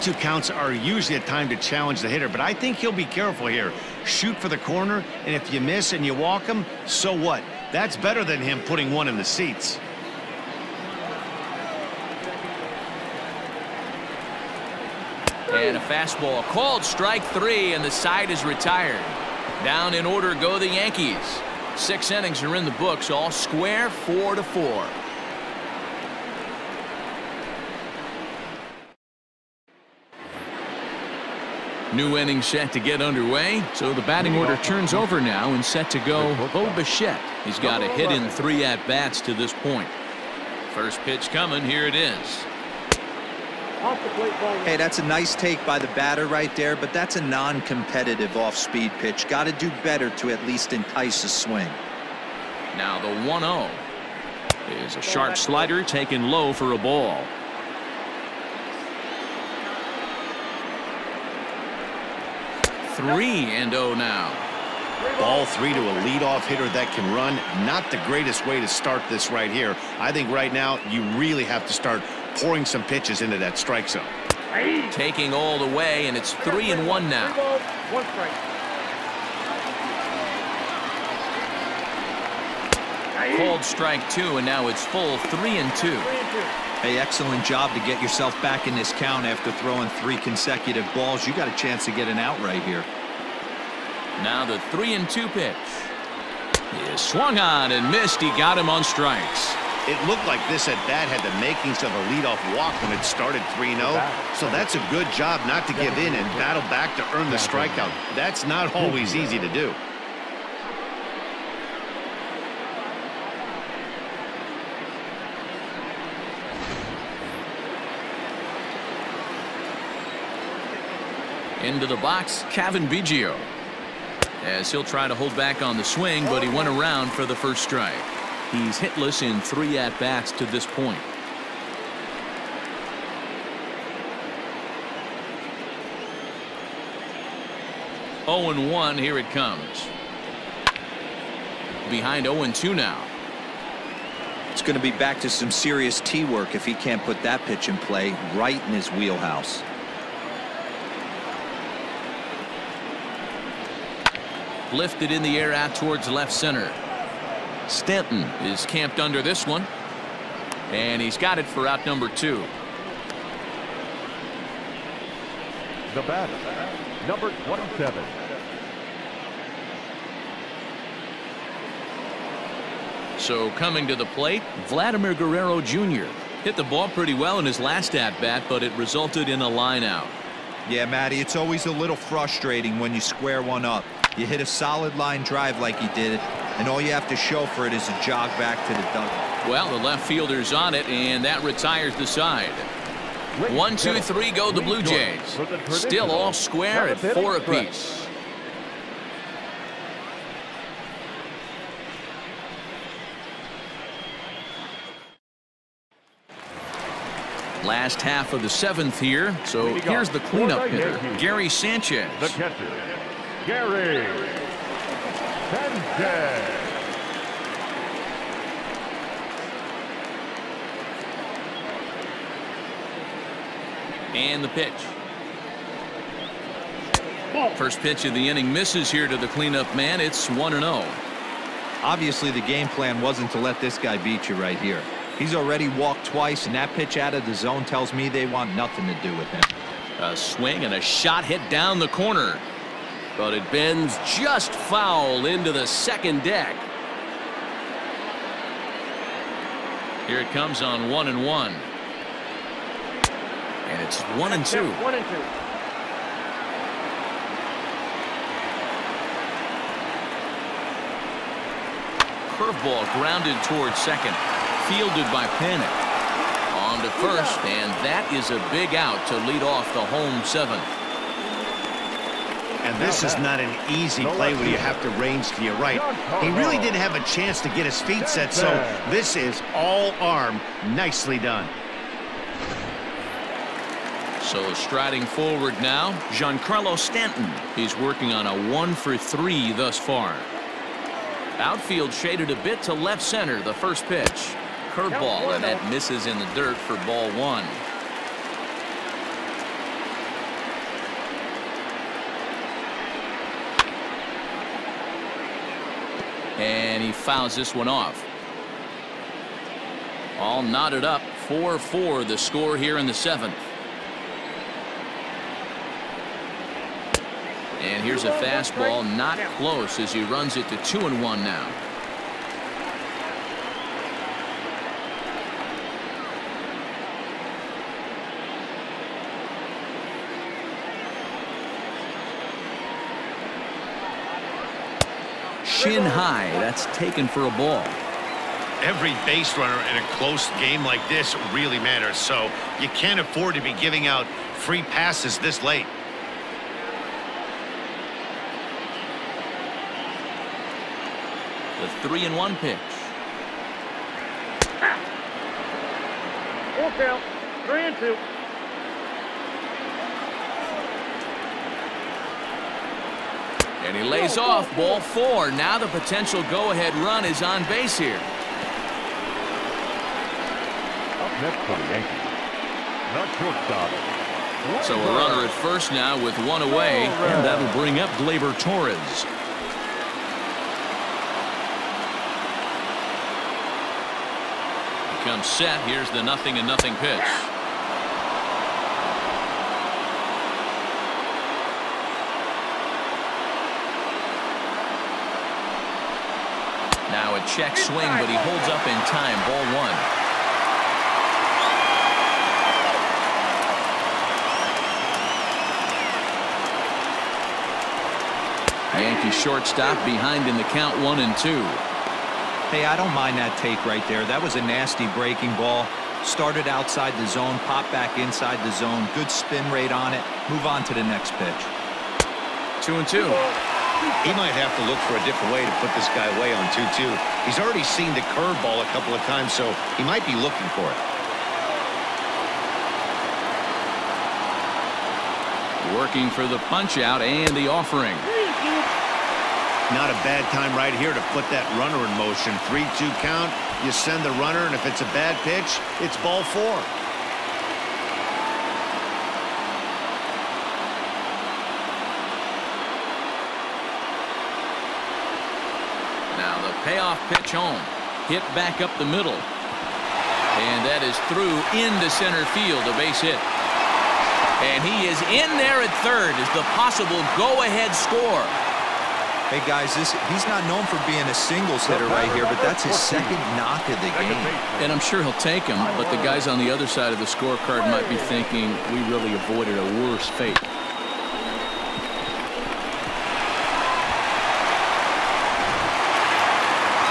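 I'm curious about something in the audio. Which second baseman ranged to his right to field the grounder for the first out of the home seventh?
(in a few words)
Panik.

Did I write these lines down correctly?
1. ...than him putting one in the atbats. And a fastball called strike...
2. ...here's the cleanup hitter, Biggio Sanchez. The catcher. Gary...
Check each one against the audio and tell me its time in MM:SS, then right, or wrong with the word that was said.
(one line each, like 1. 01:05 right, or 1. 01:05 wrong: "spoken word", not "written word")
1. 00:08 wrong: "seats", not "atbats"
2. 03:29 wrong: "Gary", not "Biggio".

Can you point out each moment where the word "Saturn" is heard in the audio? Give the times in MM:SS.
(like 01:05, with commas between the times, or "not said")
not said.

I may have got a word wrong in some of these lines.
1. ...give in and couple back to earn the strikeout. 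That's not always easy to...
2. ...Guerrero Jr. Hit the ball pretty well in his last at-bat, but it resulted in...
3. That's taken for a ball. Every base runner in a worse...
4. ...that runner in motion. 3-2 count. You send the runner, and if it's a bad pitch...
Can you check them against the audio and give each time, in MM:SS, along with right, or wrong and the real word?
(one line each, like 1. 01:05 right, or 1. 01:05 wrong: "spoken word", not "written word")
1. 01:45 wrong: "battle", not "couple"
2. 02:55 right
3. 05:36 wrong: "close", not "worse"
4. 07:21 right.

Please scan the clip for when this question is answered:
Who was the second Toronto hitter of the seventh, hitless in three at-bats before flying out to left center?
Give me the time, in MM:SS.
02:02.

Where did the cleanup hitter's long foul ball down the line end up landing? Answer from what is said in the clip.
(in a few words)
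The second deck.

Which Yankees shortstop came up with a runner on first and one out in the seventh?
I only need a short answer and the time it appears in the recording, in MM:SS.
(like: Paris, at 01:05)
Gleyber Torres, at 06:18.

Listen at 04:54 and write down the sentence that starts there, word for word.
Curveball, and that misses in the dirt for ball one.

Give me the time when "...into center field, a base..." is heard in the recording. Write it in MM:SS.
07:41.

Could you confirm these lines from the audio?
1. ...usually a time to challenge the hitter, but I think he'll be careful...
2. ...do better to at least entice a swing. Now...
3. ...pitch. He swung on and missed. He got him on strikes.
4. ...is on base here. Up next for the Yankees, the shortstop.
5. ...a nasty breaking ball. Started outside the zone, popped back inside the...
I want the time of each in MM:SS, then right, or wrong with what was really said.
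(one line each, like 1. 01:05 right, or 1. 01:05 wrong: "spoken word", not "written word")
1. 00:00 right
2. 00:49 right
3. 01:35 right
4. 06:07 right
5. 06:54 right.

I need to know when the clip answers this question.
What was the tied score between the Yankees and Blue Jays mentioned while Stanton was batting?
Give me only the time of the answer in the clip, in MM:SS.
05:11.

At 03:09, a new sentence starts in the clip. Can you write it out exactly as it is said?
Well, the left fielder's on it, and that retires the side.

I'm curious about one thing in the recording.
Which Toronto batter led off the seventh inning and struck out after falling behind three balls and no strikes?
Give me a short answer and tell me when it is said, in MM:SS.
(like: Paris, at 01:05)
Bo Bichette, at 00:36.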